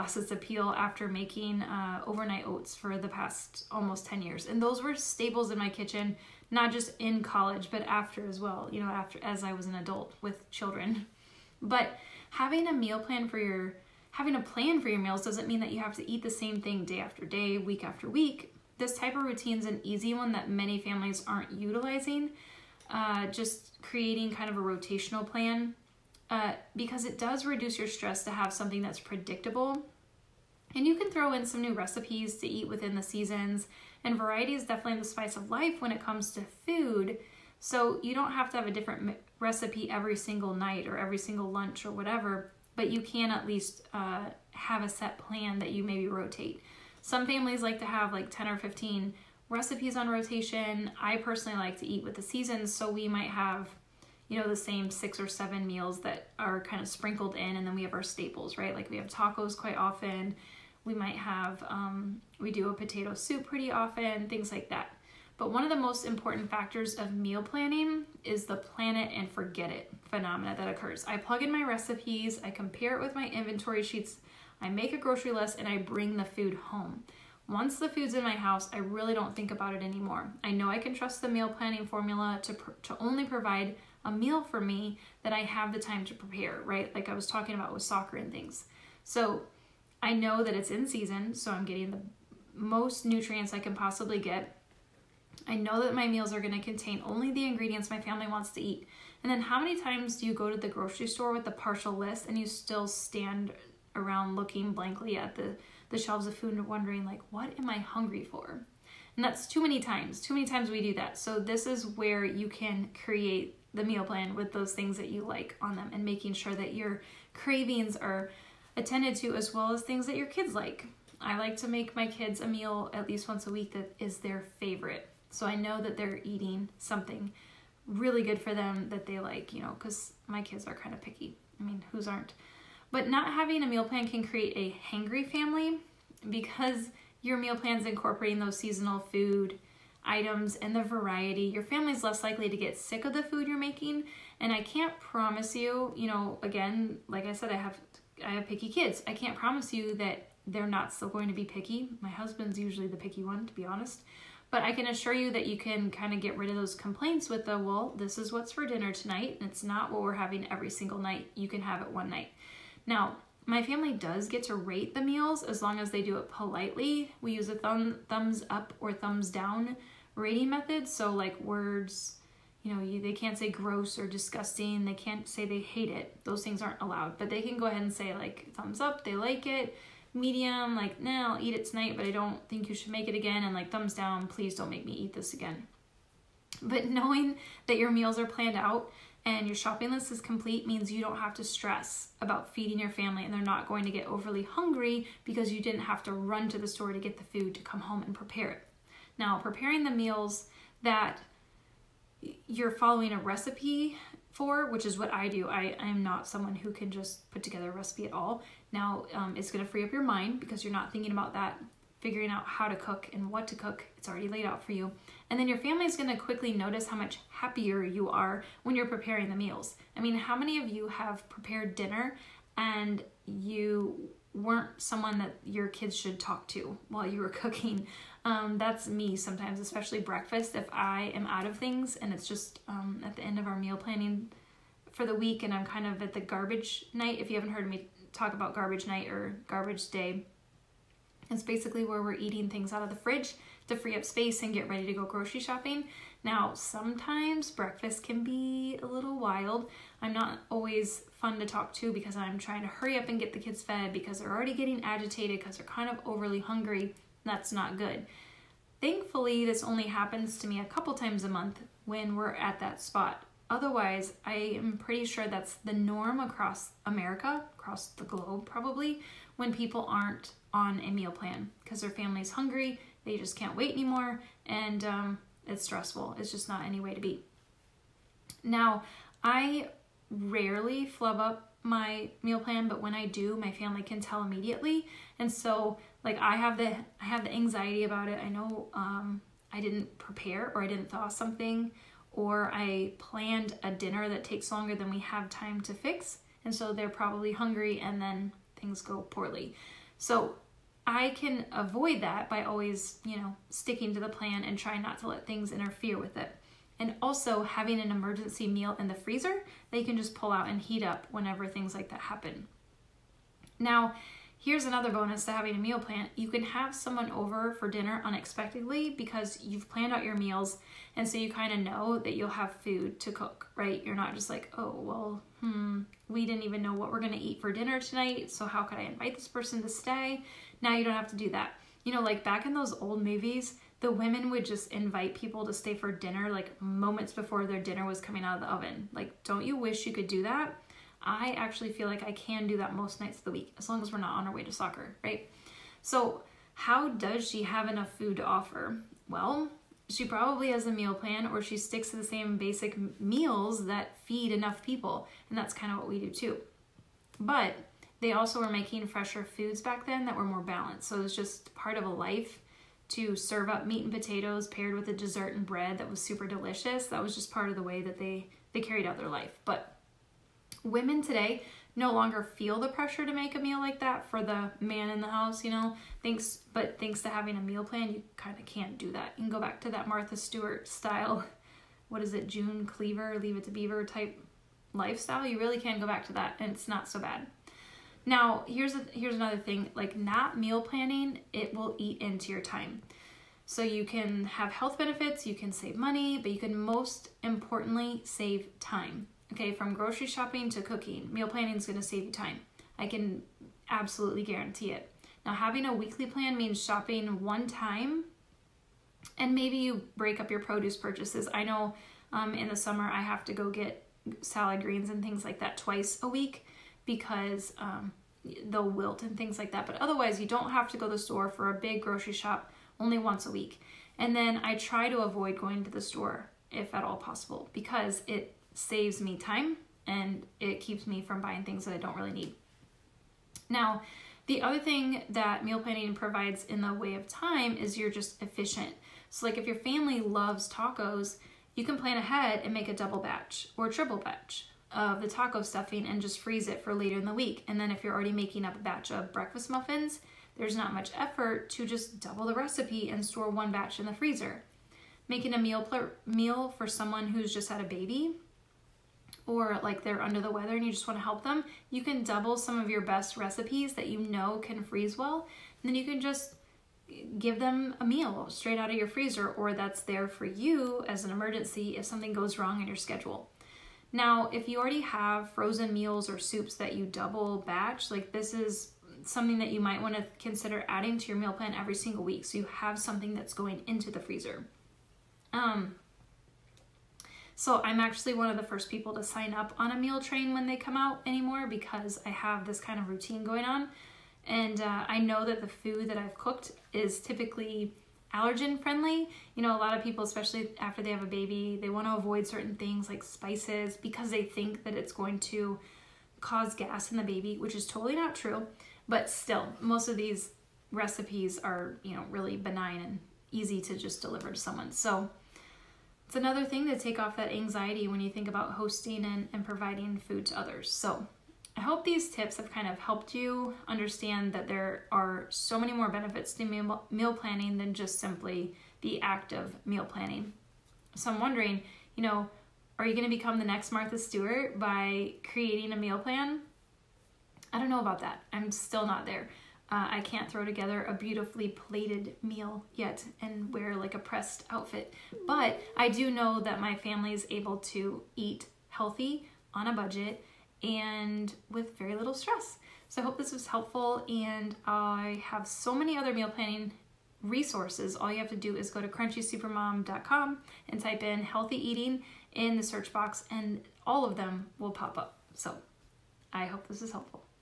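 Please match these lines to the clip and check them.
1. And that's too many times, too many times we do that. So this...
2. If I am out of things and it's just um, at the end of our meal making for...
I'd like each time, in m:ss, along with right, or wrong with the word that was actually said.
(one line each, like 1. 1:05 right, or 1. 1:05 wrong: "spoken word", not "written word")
1. 1:49 right
2. 3:50 wrong: "planning", not "making".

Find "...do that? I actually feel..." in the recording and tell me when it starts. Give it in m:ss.
5:40.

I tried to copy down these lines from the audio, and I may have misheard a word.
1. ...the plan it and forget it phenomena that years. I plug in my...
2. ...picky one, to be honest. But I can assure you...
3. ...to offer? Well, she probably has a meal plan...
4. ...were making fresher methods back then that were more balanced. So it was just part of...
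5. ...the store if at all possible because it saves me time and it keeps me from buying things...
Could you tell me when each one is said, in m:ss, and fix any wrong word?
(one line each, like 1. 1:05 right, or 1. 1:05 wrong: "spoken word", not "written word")
1. 1:08 wrong: "occurs", not "years"
2. 2:32 right
3. 5:48 right
4. 5:58 wrong: "foods", not "methods"
5. 7:05 right.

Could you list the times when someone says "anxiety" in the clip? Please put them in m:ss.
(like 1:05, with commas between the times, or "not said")
4:47, 8:37.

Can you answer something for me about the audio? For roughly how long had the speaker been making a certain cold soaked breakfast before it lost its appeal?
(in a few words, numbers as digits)
almost 10 years.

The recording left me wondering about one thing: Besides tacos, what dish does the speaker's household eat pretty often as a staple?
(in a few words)
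potato soup.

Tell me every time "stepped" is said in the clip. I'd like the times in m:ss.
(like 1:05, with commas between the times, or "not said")
not said.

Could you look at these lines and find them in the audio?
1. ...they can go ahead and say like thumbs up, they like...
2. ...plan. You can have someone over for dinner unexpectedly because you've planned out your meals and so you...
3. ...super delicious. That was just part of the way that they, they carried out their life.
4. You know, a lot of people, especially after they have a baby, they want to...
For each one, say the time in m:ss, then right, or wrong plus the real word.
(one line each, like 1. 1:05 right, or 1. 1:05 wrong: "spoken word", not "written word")
1. 2:57 right
2. 5:15 right
3. 6:06 right
4. 8:19 right.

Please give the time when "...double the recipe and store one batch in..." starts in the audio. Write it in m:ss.
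7:31.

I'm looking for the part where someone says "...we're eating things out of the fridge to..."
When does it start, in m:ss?
4:02.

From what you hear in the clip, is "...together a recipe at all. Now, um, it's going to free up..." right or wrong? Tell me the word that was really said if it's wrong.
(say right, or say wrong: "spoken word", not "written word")
right.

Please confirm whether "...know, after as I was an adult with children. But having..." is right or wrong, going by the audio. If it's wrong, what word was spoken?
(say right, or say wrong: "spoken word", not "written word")
right.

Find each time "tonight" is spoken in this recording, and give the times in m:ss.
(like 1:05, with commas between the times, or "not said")
2:38, 3:01, 5:27.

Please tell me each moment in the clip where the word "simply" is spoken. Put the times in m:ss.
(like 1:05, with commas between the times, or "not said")
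8:47.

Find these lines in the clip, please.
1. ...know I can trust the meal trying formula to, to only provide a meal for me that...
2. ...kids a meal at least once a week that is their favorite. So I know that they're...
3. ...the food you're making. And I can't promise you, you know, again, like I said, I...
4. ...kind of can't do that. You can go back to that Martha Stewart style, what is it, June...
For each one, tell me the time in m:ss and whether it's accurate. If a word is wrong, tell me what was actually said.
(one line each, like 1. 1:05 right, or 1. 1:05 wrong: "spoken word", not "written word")
1. 1:20 wrong: "planning", not "trying"
2. 2:02 right
3. 2:23 right
4. 6:18 right.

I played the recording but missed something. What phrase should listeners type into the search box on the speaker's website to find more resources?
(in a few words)
healthy eating.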